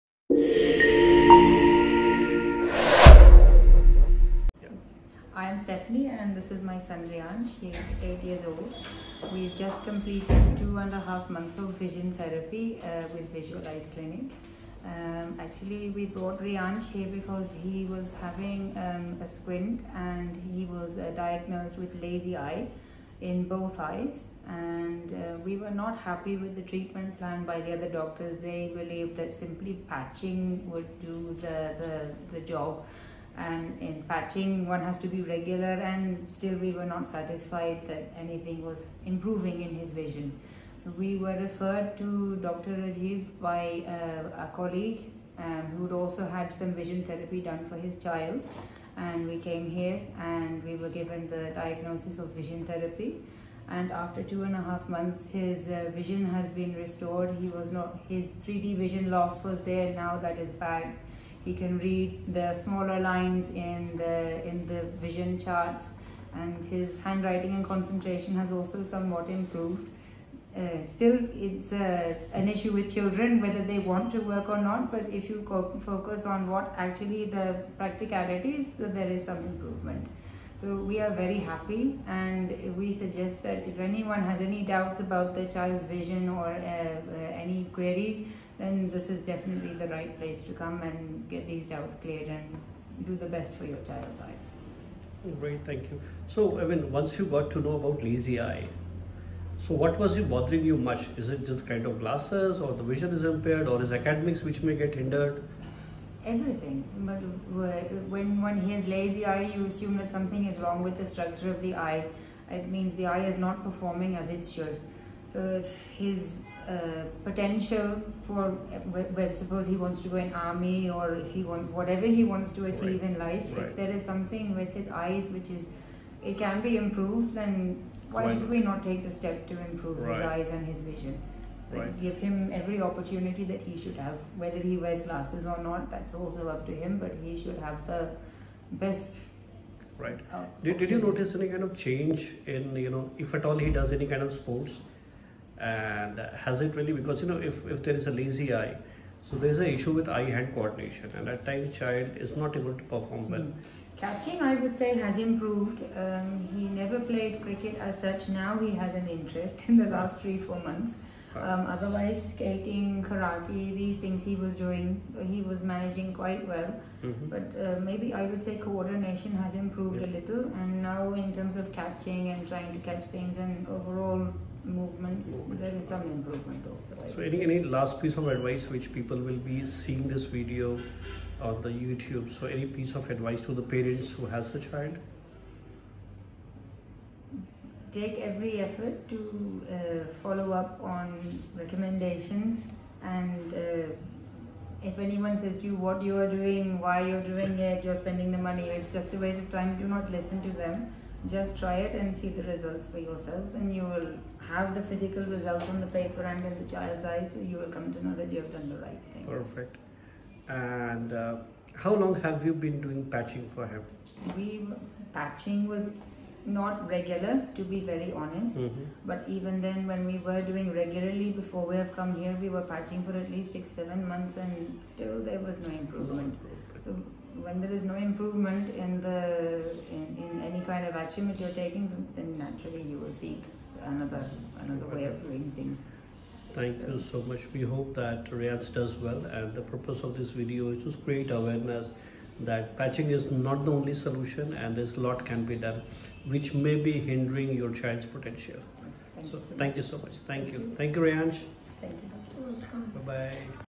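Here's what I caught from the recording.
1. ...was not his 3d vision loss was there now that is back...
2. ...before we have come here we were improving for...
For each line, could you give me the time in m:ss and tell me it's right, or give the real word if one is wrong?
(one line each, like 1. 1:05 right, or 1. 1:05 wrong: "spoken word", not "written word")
1. 0:57 right
2. 3:41 wrong: "patching", not "improving".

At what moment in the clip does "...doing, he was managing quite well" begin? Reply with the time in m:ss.
2:44.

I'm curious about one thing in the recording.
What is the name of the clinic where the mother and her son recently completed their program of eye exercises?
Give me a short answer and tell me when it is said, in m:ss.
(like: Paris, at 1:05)
Visual Eyez Clinic, at 0:13.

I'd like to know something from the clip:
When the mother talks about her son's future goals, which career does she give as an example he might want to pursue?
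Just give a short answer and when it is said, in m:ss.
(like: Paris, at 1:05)
Army, at 2:00.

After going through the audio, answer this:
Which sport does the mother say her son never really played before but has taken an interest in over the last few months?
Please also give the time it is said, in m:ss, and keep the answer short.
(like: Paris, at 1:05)
Cricket, at 2:37.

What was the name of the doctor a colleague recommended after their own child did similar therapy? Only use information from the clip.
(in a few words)
Dr. Rajiv.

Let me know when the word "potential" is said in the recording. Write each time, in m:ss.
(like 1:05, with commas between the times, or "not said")
1:57, 4:08.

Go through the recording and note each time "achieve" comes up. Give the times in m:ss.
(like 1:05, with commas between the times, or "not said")
2:02.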